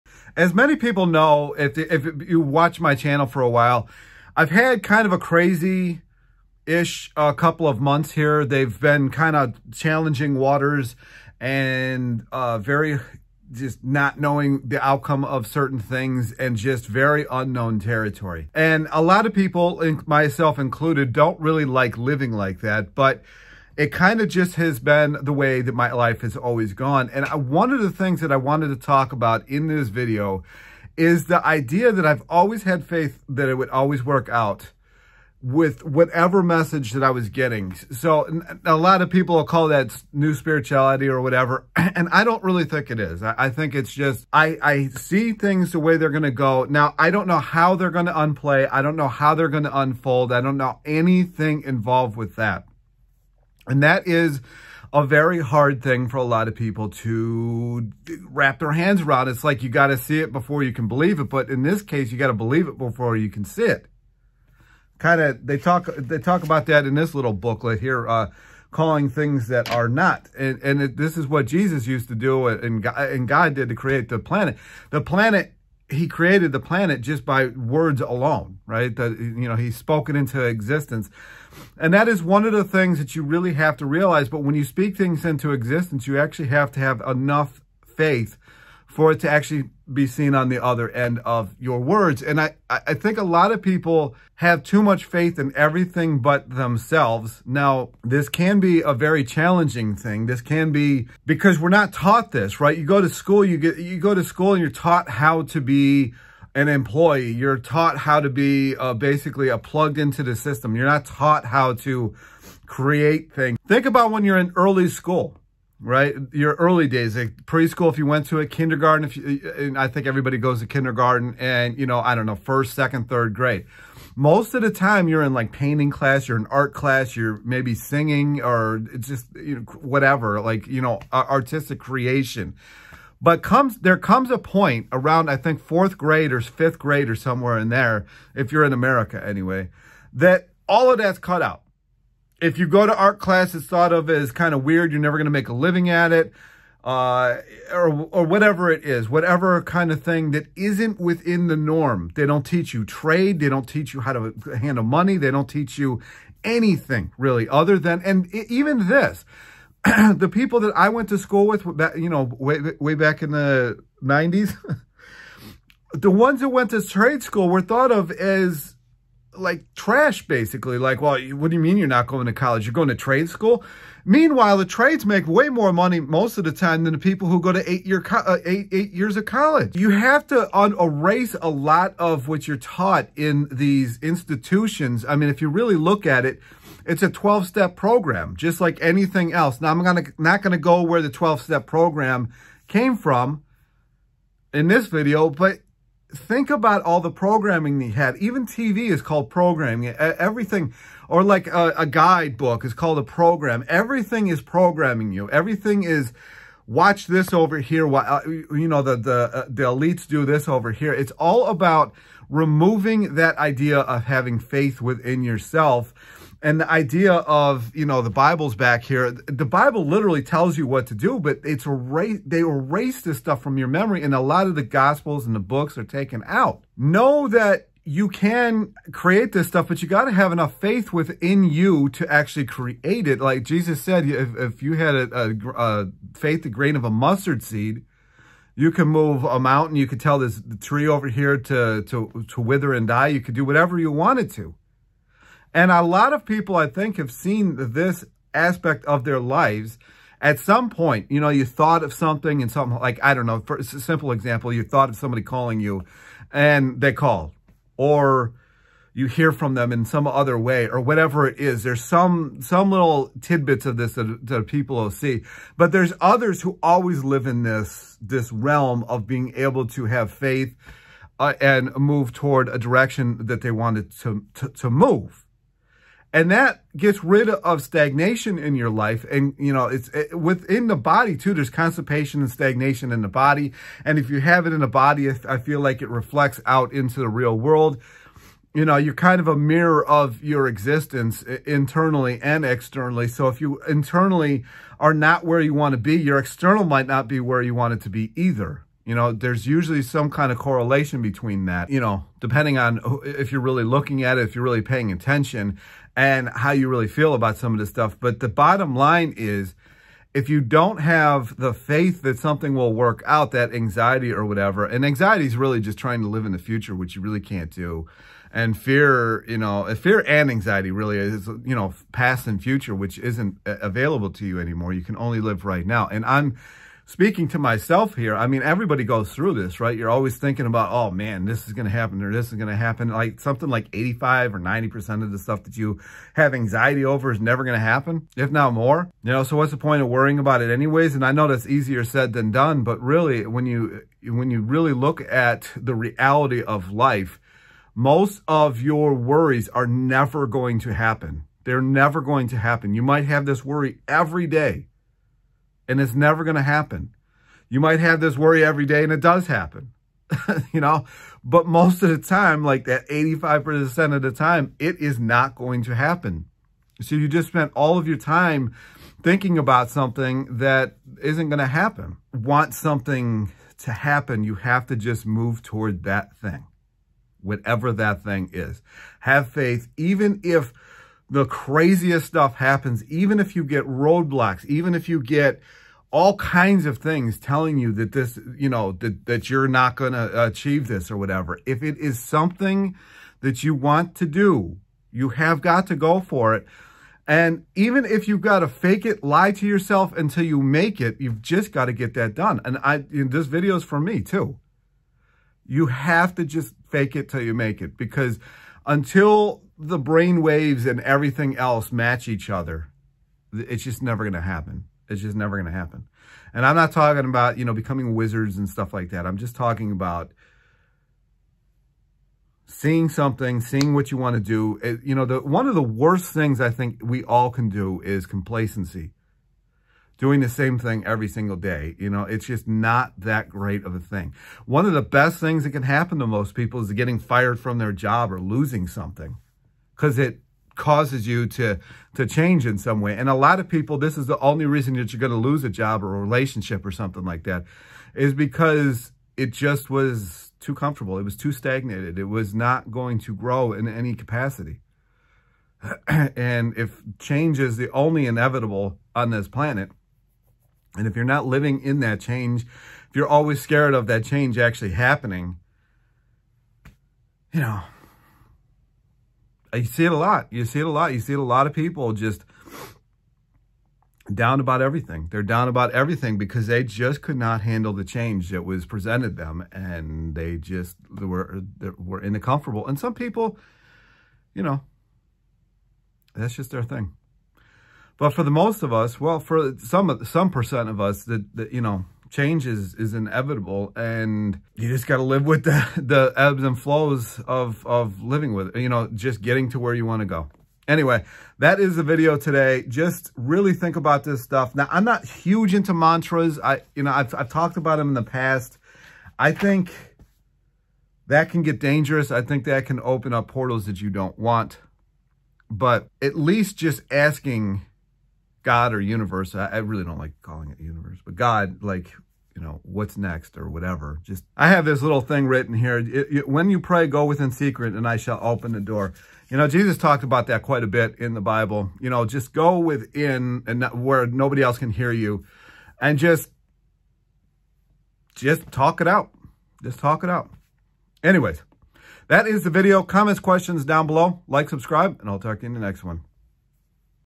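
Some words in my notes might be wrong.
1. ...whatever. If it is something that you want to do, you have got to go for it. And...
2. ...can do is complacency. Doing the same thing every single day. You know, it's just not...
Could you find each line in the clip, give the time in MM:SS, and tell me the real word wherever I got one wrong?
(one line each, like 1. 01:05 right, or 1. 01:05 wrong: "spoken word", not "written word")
1. 06:30 right
2. 07:07 right.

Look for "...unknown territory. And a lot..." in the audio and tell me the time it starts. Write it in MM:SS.
00:17.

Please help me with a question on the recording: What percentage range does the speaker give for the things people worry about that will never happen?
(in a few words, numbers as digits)
85 or 90%.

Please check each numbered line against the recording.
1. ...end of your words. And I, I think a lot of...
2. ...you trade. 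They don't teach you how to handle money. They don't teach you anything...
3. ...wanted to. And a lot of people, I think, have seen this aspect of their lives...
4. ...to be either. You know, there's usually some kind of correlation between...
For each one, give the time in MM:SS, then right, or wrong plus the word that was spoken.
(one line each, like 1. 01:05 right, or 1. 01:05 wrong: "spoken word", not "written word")
1. 01:30 right
2. 02:32 right
3. 04:03 right
4. 04:57 right.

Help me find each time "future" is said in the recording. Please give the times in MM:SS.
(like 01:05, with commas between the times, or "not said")
05:16, 05:22.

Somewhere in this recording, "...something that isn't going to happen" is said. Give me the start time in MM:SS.
06:09.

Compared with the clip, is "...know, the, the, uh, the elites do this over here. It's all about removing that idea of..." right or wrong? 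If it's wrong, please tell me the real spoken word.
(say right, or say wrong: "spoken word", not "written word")
right.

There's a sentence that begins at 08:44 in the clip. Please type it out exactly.
Just, I have this little thing written here.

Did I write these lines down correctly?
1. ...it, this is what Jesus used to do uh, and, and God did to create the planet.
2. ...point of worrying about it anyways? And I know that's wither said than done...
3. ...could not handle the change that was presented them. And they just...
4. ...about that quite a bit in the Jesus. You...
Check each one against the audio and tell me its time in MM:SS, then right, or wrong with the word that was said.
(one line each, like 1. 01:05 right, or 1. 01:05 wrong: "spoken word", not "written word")
1. 01:10 right
2. 05:39 wrong: "easier", not "wither"
3. 07:57 right
4. 08:50 wrong: "Bible", not "Jesus".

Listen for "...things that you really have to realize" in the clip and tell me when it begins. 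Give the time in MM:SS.
01:22.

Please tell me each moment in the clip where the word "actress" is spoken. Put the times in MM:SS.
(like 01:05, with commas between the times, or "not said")
not said.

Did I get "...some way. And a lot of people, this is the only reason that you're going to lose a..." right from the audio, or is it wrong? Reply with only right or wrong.
right.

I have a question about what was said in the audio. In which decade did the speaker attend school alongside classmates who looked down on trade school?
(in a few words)
The 90s.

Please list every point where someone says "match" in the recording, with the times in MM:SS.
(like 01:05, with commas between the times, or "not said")
06:51.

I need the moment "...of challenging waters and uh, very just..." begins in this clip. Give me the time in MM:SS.
00:09.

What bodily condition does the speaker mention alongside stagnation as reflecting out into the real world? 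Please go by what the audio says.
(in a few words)
Constipation.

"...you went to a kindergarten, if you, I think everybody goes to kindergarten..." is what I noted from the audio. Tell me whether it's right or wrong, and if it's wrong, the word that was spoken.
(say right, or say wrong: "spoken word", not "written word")
right.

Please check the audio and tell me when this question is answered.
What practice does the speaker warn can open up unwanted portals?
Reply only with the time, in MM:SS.
08:25.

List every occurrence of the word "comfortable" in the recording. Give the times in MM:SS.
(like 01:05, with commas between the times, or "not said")
07:30, 08:02.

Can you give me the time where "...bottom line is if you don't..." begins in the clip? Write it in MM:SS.
05:08.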